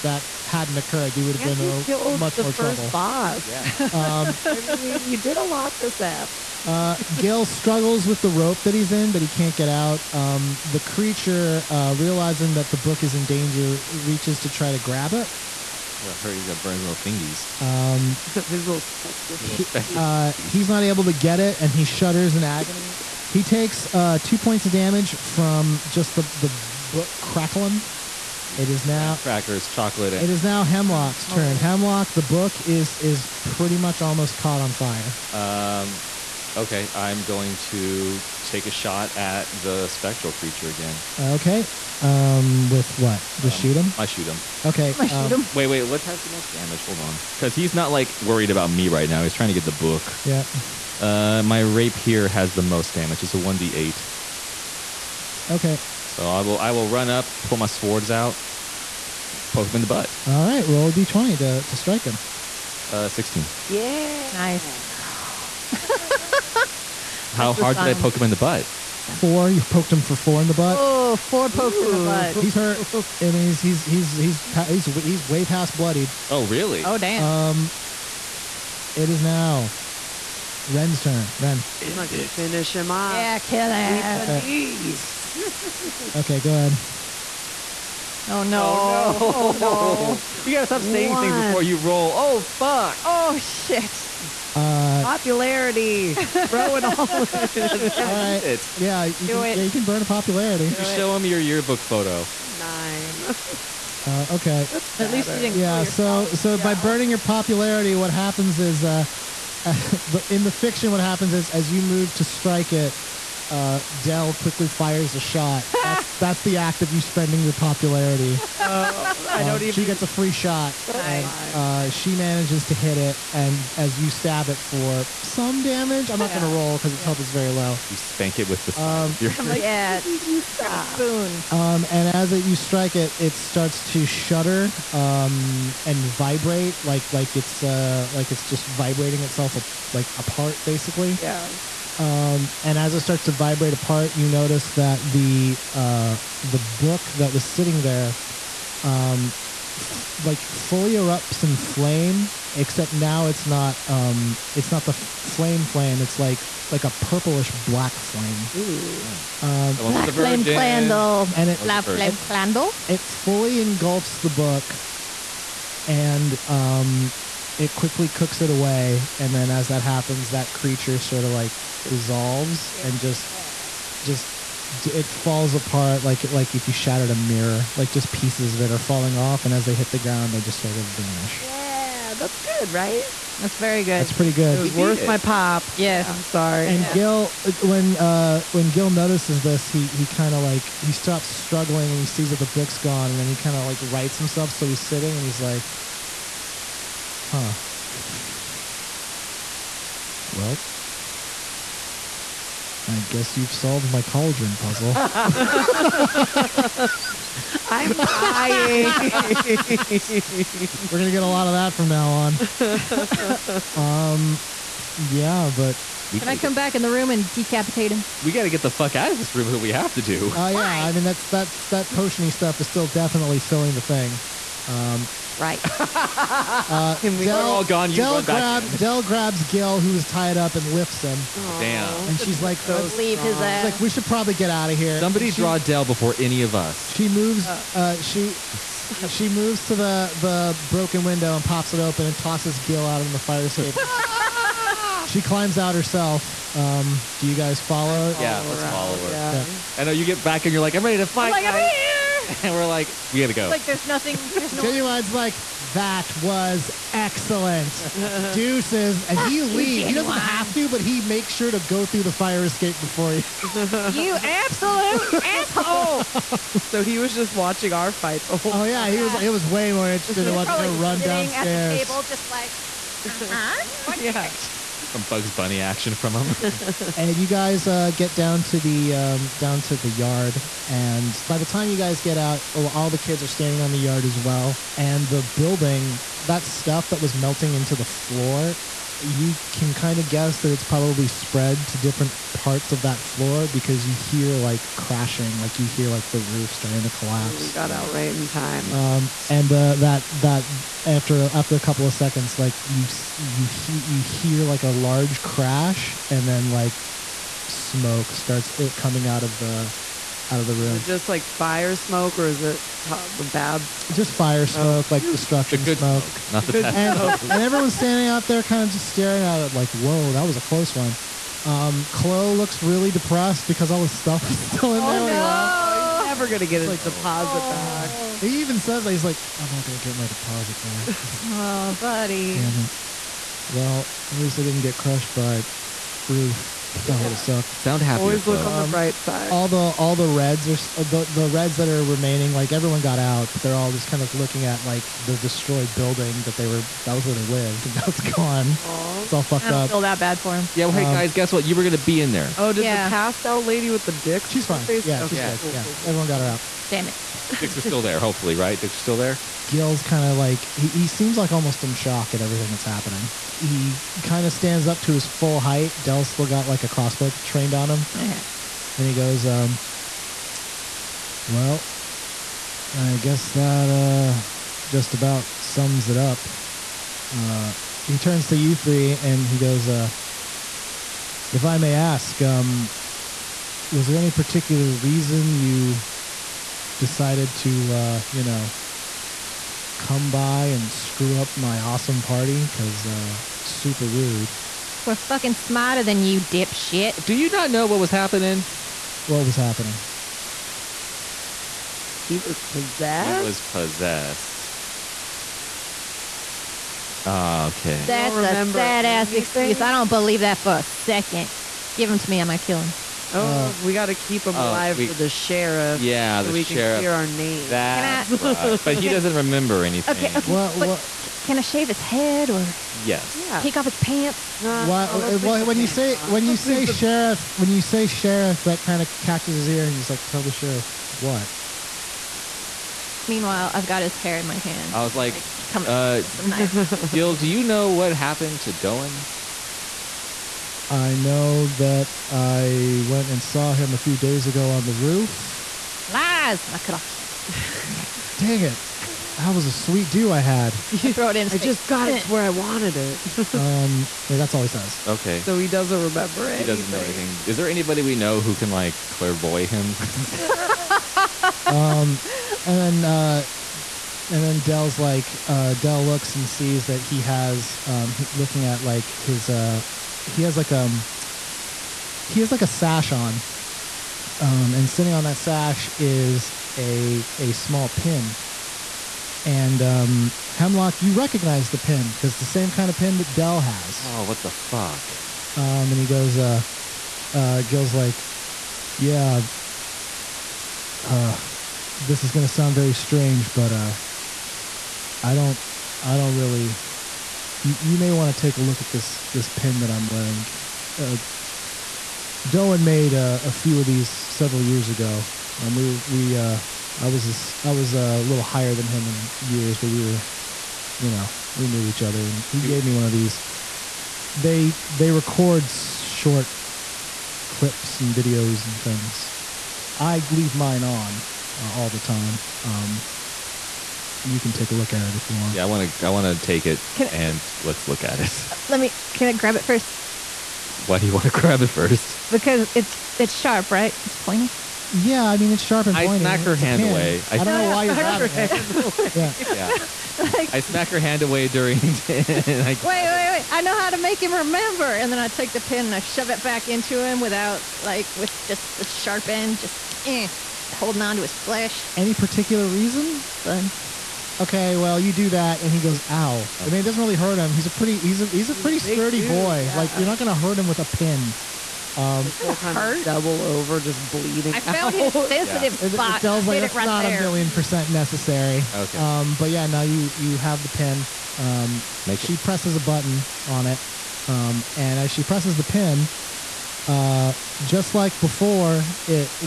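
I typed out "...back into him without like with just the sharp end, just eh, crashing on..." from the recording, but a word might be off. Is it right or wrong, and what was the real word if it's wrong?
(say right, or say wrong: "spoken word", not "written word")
wrong: "holding", not "crashing".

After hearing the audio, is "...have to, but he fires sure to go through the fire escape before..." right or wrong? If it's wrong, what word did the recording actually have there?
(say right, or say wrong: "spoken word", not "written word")
wrong: "makes", not "fires".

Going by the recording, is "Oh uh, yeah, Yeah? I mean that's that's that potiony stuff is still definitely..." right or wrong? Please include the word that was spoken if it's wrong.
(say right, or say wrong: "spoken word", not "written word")
wrong: "Why", not "Yeah".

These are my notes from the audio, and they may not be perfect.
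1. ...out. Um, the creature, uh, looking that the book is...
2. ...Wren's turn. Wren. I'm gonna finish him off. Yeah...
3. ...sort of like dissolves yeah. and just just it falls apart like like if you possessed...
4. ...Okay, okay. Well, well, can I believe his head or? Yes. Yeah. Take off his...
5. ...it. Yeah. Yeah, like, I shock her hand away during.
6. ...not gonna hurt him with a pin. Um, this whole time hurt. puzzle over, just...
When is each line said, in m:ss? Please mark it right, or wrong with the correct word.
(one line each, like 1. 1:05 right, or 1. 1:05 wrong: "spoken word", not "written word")
1. 0:09 wrong: "realizing", not "looking"
2. 1:20 right
3. 2:50 wrong: "shattered", not "possessed"
4. 6:59 wrong: "shave", not "believe"
5. 8:58 wrong: "smack", not "shock"
6. 9:19 wrong: "double", not "puzzle".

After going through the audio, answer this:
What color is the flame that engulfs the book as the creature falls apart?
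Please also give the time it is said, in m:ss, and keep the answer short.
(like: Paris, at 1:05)
purplish black, at 2:36.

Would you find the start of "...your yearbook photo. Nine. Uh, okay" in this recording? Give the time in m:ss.
1:41.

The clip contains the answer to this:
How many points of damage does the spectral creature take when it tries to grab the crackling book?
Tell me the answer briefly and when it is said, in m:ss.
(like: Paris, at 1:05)
2, at 0:24.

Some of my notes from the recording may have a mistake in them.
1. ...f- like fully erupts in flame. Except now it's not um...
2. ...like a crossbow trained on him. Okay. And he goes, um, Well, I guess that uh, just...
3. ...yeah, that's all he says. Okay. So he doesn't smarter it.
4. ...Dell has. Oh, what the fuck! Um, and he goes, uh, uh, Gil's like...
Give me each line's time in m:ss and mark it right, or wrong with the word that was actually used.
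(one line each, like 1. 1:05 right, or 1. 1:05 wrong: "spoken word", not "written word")
1. 2:29 right
2. 6:06 right
3. 7:34 wrong: "remember", not "smarter"
4. 8:03 right.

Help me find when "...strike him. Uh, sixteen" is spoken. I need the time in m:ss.
1:01.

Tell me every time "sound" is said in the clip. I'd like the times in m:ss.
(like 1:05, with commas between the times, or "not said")
5:37, 8:12.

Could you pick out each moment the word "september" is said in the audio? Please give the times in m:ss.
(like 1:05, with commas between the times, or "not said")
not said.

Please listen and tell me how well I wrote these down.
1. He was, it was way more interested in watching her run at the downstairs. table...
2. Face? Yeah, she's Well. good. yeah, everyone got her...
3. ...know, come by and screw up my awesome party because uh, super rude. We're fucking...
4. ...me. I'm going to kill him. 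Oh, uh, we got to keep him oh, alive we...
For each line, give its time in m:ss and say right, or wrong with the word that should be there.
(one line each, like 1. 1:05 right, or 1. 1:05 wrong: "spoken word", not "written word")
1. 4:28 right
2. 5:54 wrong: "Okay", not "Well"
3. 6:28 right
4. 6:52 right.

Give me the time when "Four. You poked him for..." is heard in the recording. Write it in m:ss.
1:09.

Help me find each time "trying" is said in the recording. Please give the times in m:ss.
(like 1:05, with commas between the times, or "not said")
0:49.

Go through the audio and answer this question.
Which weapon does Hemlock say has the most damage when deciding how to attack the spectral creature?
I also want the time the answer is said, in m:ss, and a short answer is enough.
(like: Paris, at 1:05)
rapier, at 0:51.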